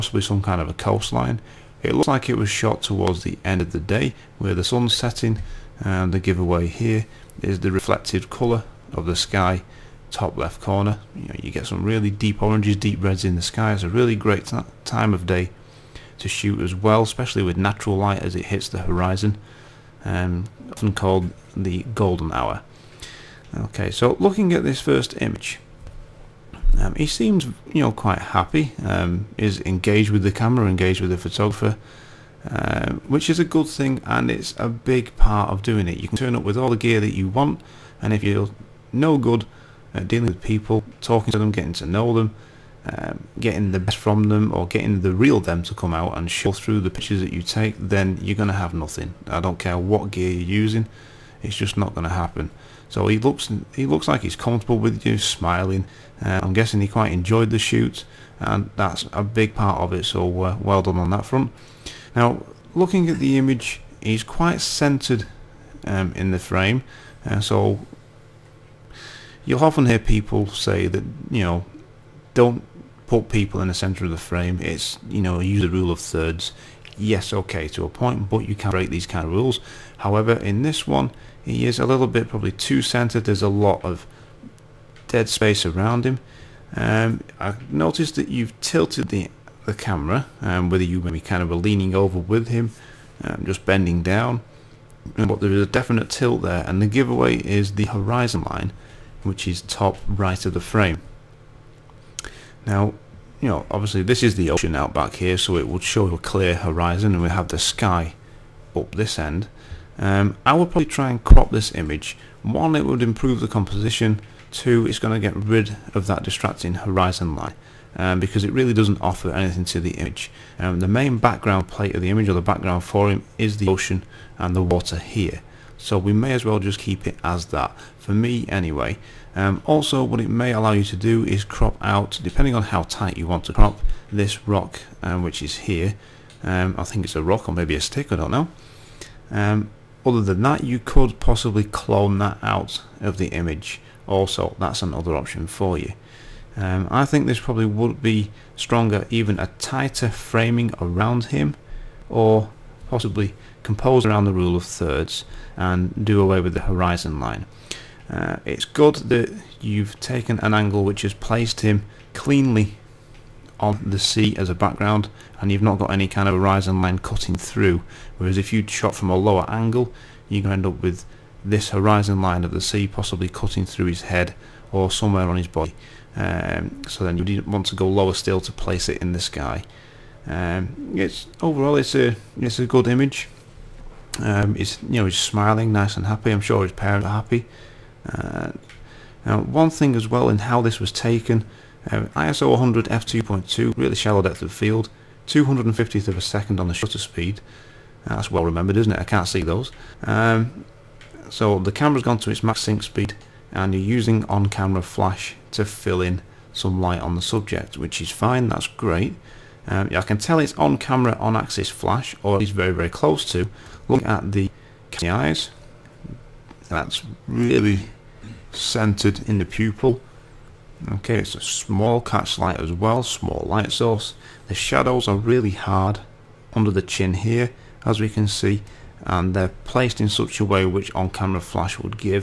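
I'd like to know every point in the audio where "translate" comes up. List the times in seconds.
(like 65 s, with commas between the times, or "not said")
not said.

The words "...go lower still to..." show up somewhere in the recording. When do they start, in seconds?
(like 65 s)
177 s.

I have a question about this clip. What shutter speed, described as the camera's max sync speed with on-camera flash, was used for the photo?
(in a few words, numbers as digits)
1/250 second.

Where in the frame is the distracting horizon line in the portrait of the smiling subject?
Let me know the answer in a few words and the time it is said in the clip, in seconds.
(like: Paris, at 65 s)
top right, at 99 s.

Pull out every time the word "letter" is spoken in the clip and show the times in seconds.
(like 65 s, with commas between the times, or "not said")
not said.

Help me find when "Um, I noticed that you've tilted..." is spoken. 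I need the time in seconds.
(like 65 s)
86 s.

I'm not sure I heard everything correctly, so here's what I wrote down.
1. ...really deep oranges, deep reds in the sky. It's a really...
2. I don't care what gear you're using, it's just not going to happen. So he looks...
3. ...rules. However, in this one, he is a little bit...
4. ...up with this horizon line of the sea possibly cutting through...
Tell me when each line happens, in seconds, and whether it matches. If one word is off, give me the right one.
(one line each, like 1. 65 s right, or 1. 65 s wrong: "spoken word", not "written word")
1. 11 s right
2. 49 s right
3. 79 s right
4. 170 s right.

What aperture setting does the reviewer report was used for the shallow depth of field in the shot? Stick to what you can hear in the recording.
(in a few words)
f2.2.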